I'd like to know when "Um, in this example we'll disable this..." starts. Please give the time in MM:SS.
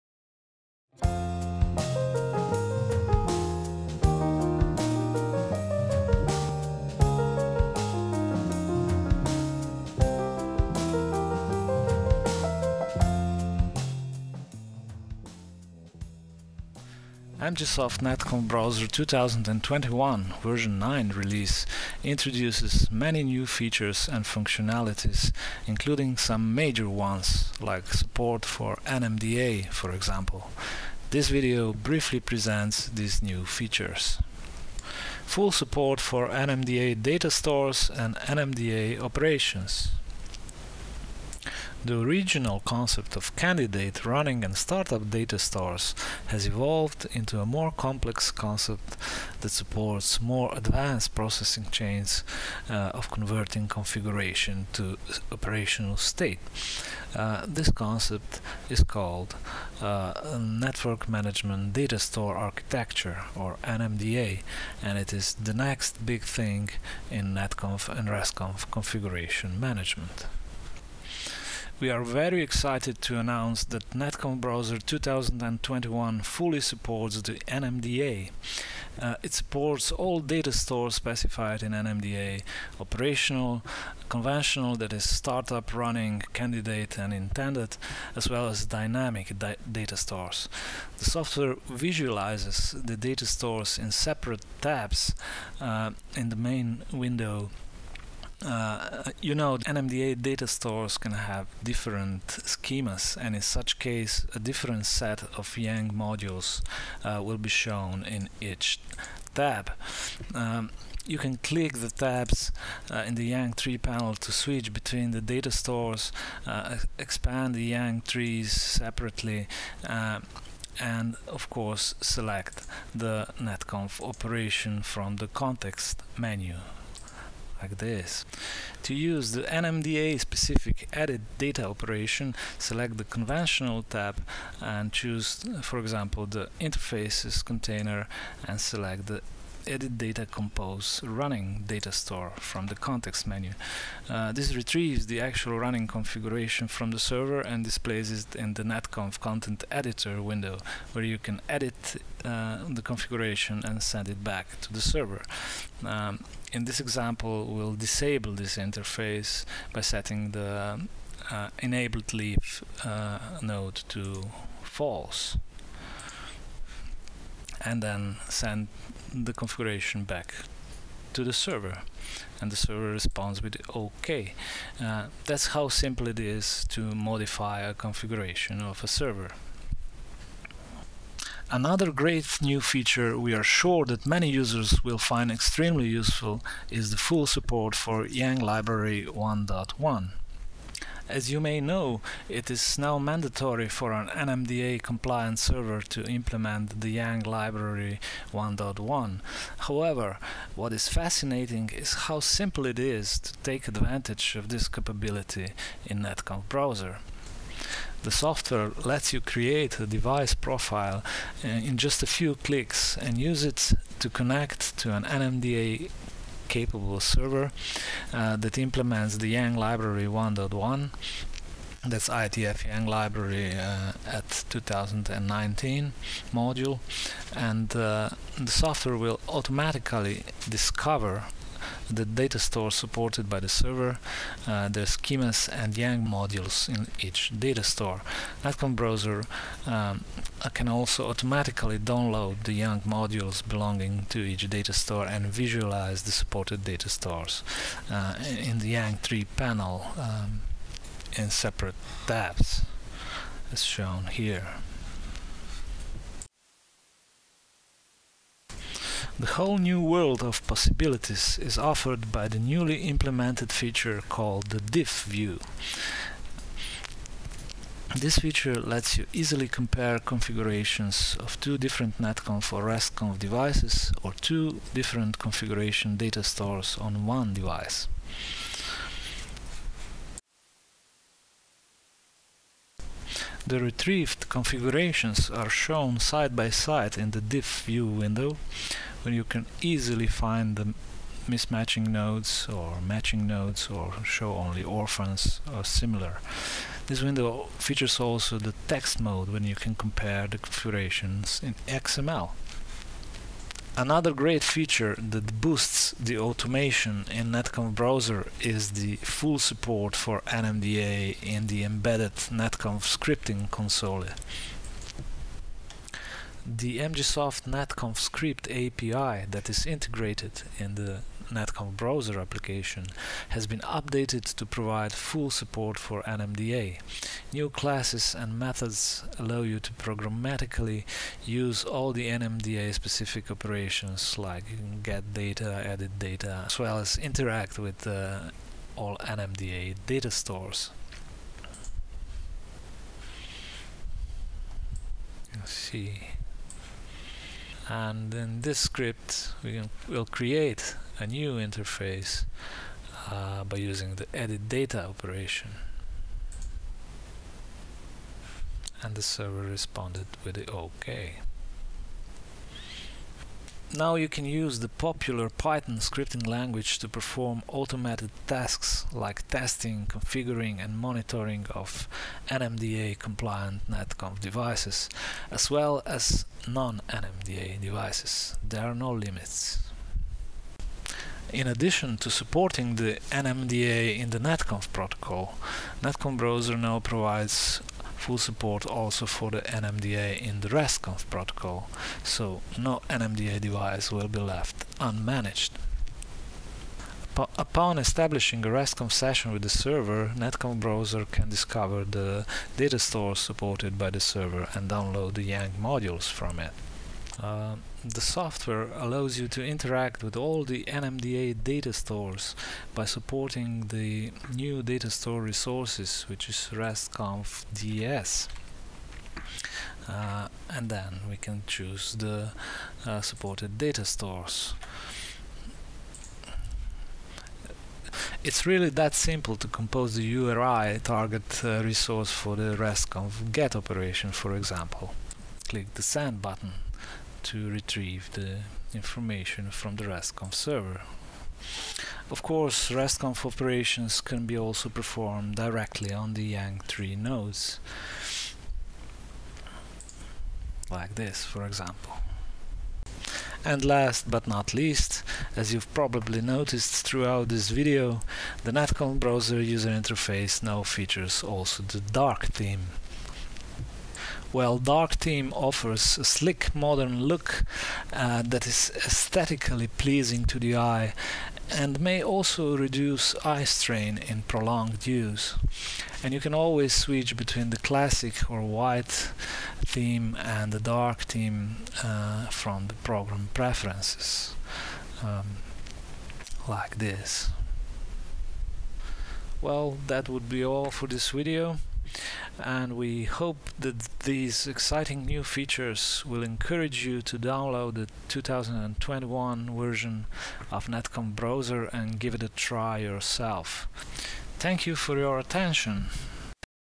02:35.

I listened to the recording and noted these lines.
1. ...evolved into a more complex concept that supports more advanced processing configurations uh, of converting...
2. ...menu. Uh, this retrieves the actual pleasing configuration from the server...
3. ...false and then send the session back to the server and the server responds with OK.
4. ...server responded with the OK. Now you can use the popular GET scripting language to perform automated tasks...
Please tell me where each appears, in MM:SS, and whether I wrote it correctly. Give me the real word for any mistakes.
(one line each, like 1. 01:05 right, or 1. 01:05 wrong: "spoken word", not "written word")
1. 00:46 wrong: "chains", not "configurations"
2. 02:23 wrong: "running", not "pleasing"
3. 02:44 wrong: "configuration", not "session"
4. 05:59 wrong: "Python", not "GET".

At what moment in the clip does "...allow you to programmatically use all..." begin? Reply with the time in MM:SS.
05:29.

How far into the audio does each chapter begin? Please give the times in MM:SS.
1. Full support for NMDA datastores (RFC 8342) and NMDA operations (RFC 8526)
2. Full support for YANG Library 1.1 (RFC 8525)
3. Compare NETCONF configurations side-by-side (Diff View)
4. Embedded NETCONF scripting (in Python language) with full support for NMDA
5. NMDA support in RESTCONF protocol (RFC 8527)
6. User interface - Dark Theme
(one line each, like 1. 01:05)
1. 00:35
2. 03:00
3. 04:18
4. 05:02
5. 06:20
6. 07:33.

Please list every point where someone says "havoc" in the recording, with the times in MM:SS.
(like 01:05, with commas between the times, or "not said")
not said.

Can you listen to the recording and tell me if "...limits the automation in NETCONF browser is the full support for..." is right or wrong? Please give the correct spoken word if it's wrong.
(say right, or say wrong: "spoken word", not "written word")
wrong: "boosts", not "limits".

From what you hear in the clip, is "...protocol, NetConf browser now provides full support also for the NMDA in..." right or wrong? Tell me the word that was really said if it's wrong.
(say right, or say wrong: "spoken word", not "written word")
right.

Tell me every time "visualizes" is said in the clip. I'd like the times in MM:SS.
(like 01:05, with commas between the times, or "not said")
01:31, 04:05.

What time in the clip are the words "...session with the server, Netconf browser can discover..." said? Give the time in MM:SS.
06:38.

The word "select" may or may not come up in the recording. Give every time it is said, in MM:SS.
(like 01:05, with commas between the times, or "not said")
02:02, 02:12, 02:18.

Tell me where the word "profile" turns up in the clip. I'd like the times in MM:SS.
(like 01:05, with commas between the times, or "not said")
03:30.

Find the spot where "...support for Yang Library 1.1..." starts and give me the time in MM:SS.
03:07.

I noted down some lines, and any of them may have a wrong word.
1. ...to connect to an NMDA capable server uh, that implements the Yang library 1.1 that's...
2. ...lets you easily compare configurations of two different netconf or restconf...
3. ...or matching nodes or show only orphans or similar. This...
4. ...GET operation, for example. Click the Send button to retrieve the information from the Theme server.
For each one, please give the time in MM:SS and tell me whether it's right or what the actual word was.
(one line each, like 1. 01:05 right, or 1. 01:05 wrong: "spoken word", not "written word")
1. 03:33 right
2. 04:28 right
3. 04:52 right
4. 07:13 wrong: "RESTCONF", not "Theme".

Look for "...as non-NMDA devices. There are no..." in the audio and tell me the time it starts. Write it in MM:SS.
06:15.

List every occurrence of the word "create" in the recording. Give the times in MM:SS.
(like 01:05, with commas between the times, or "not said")
03:29, 05:50.